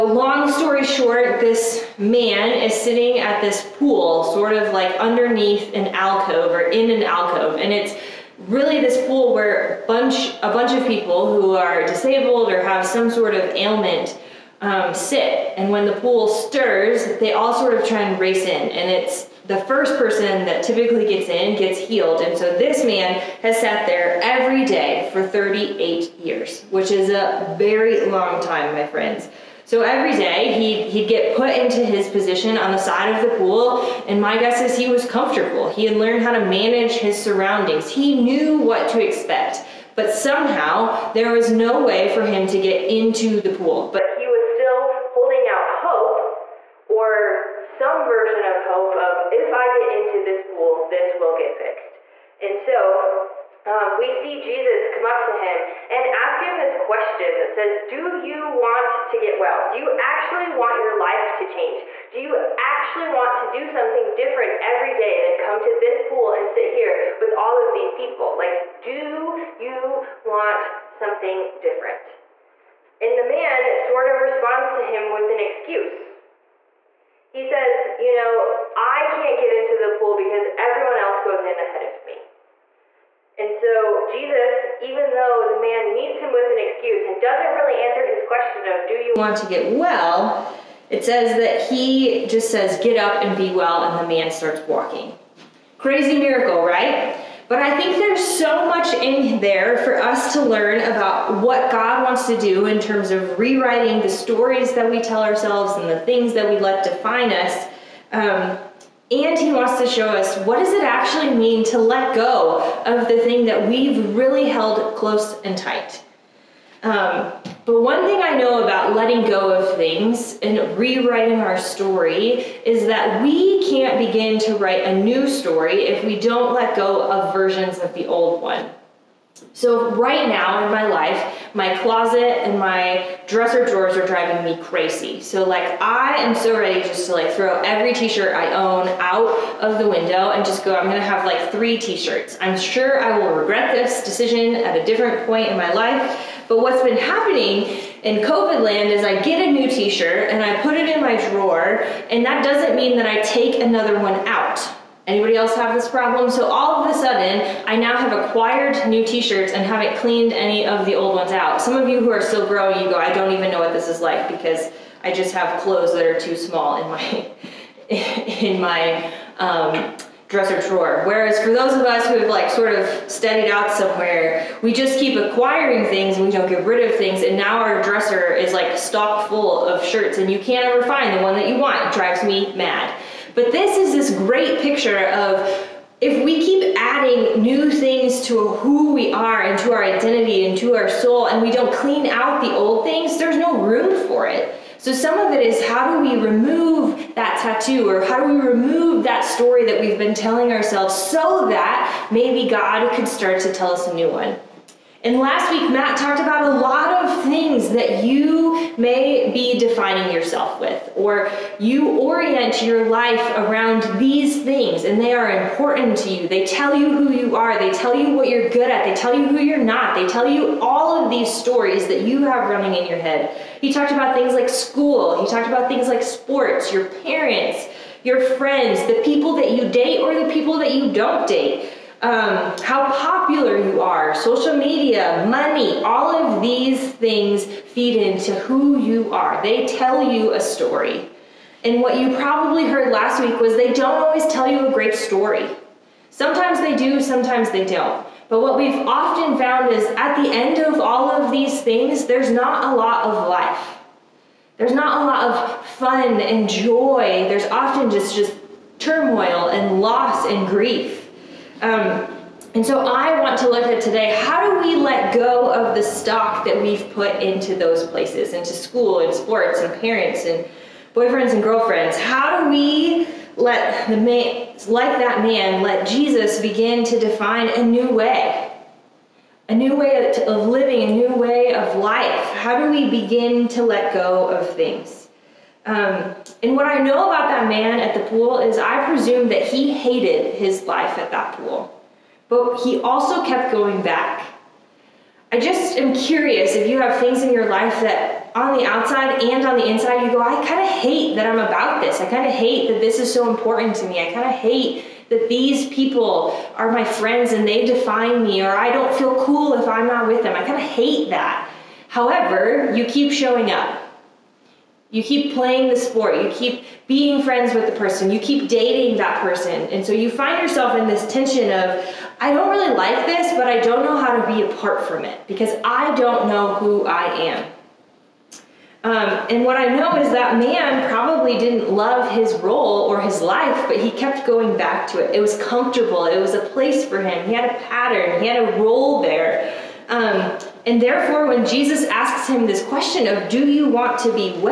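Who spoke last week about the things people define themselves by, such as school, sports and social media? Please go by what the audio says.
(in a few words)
Matt.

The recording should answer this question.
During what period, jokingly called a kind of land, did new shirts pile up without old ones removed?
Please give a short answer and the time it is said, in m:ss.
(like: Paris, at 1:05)
COVID, at 2:28.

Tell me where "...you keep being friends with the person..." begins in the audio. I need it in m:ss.
5:16.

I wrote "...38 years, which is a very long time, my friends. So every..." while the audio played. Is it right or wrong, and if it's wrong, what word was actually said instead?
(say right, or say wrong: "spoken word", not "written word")
right.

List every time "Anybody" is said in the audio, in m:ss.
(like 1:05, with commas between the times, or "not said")
2:35.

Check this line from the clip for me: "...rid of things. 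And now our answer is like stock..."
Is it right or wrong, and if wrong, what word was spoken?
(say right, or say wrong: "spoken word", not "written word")
wrong: "dresser", not "answer".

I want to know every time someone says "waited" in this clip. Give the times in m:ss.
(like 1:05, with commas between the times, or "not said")
not said.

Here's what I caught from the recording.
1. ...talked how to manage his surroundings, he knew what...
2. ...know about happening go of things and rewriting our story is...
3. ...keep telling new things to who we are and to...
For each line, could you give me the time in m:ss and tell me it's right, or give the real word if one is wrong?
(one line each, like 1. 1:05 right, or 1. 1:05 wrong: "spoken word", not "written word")
1. 0:35 wrong: "learned", not "talked"
2. 1:58 wrong: "letting", not "happening"
3. 3:06 wrong: "adding", not "telling".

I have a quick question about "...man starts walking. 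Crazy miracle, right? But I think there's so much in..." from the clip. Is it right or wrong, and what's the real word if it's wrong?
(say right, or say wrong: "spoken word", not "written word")
right.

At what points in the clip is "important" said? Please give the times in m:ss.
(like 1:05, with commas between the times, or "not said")
3:35, 5:03.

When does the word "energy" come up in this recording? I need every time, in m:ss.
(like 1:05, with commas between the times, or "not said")
not said.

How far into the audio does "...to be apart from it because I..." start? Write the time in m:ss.
5:24.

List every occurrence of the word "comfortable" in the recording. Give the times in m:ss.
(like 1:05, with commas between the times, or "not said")
0:35, 5:35.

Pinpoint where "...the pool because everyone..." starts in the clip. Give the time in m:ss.
1:19.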